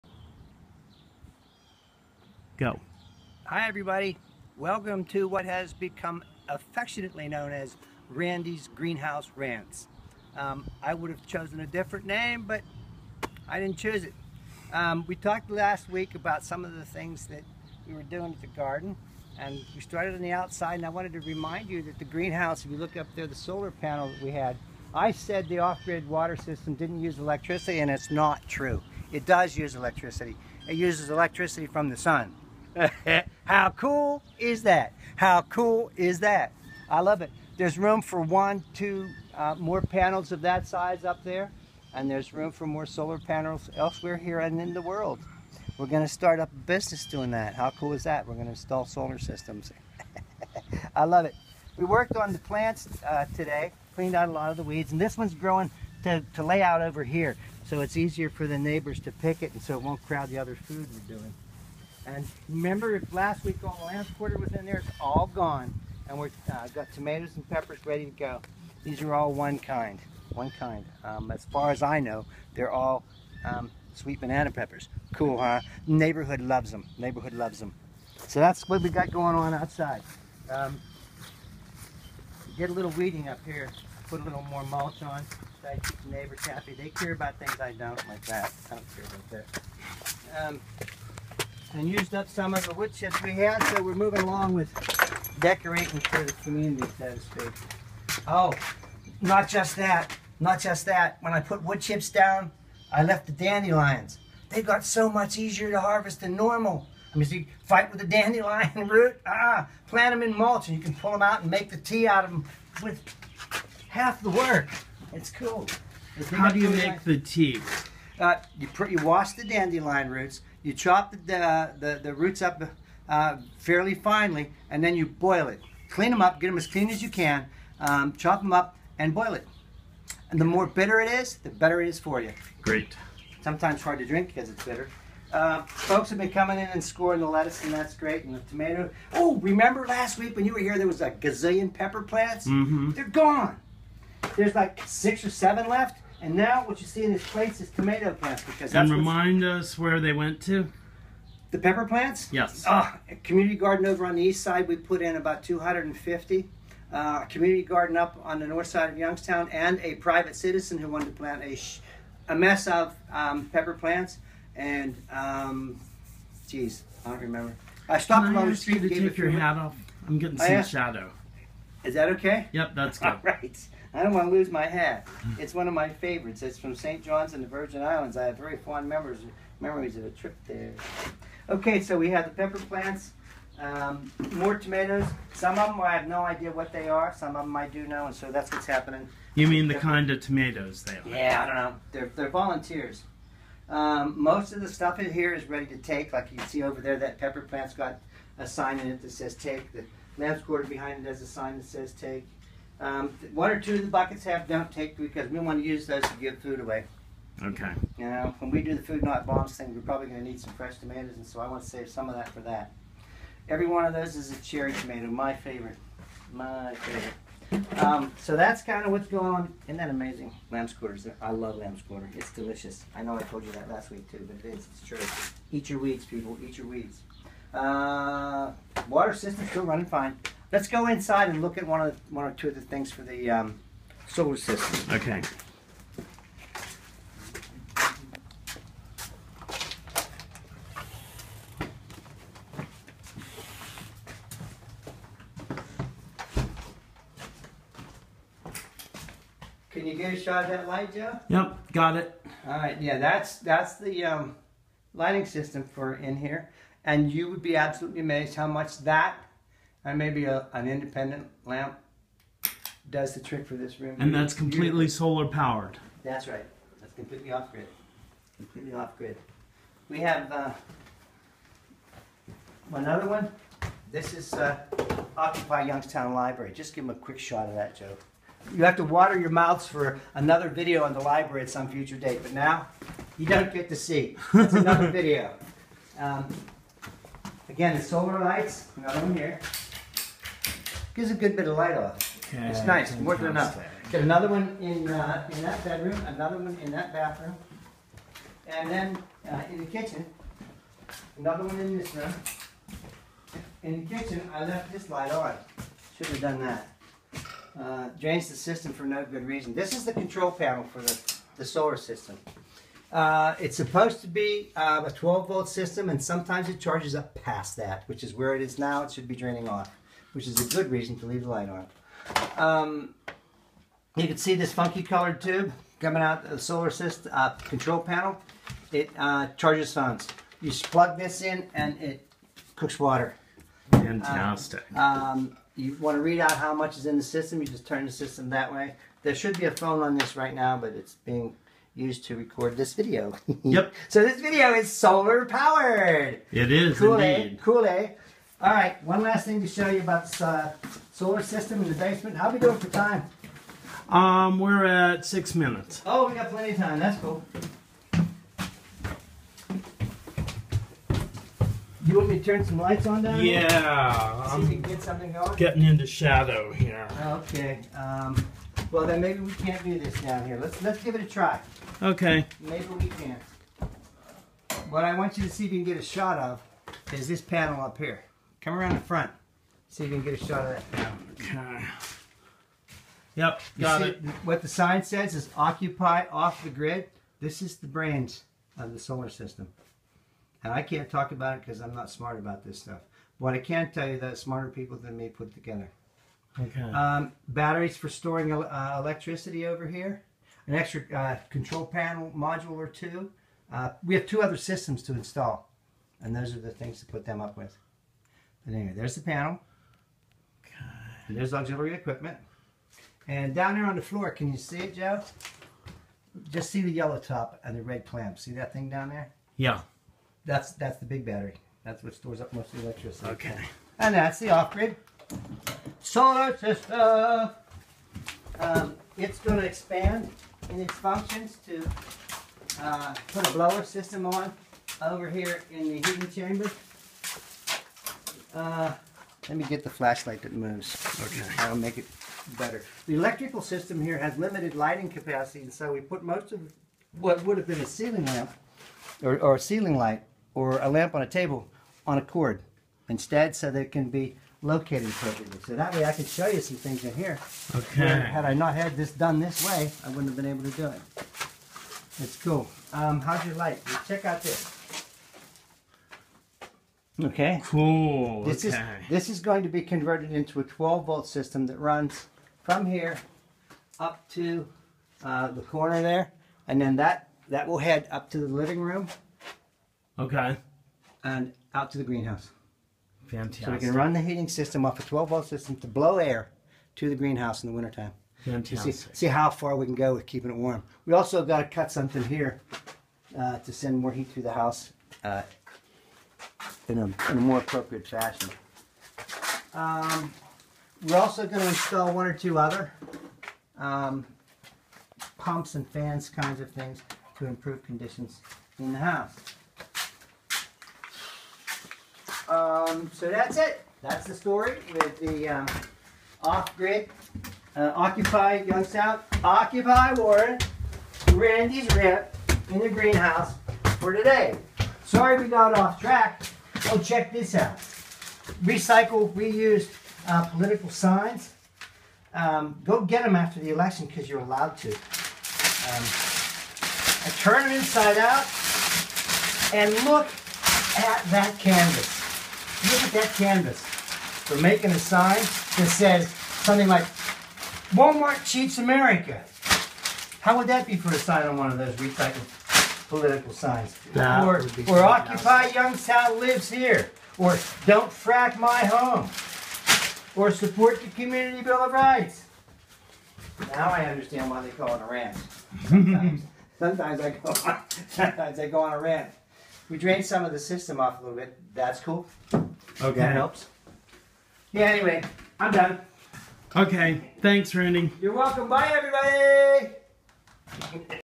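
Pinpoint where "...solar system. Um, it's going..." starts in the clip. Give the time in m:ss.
7:05.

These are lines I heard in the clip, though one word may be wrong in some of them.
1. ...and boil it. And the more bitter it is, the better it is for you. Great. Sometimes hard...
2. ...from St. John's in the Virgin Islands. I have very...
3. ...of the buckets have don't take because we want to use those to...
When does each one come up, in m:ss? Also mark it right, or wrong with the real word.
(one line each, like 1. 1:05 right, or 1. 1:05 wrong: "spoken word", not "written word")
1. 2:08 right
2. 2:56 right
3. 3:23 right.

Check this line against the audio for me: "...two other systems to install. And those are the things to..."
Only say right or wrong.
right.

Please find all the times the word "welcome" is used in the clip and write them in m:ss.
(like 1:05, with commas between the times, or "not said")
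0:04, 9:38.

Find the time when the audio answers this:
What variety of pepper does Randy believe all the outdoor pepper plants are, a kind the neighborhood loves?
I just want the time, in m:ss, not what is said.
1:13.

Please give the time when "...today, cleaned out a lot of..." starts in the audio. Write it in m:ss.
0:53.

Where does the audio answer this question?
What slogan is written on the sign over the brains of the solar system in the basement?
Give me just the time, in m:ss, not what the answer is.
6:25.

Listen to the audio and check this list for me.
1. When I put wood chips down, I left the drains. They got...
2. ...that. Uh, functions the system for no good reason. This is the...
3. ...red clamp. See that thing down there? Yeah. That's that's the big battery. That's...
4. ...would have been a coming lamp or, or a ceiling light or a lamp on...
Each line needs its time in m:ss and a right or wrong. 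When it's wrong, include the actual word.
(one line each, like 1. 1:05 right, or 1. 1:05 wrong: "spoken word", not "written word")
1. 1:41 wrong: "dandelions", not "drains"
2. 5:06 wrong: "drains", not "functions"
3. 6:57 right
4. 7:27 wrong: "ceiling", not "coming".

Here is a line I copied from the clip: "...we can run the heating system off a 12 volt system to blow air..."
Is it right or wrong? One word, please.
right.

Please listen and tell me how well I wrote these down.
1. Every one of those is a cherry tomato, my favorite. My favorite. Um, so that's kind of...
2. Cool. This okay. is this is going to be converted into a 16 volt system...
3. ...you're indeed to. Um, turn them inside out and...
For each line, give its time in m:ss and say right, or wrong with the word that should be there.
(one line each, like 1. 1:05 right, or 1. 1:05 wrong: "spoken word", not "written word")
1. 3:33 right
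2. 7:47 wrong: "12", not "16"
3. 8:54 wrong: "allowed", not "indeed".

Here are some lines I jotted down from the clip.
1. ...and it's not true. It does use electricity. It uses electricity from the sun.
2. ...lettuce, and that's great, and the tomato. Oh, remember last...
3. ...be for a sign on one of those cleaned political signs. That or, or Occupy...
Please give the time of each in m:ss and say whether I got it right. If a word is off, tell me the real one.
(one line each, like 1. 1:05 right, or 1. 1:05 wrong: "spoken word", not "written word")
1. 0:27 right
2. 2:17 right
3. 9:10 wrong: "recycled", not "cleaned".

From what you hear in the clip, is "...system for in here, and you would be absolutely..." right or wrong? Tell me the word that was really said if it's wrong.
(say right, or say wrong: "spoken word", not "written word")
right.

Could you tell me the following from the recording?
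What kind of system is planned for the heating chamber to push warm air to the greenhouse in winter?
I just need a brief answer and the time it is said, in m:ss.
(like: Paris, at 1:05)
Blower system, at 7:13.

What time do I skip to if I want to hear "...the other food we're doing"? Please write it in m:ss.
1:00.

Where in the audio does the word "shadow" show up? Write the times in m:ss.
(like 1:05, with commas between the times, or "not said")
2:50, 6:05.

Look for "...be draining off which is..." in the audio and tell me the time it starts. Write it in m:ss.
5:19.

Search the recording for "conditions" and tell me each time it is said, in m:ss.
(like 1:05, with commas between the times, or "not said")
8:27.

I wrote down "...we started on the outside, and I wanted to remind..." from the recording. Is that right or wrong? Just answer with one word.
right.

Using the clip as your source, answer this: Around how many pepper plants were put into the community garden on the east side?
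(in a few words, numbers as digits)
250.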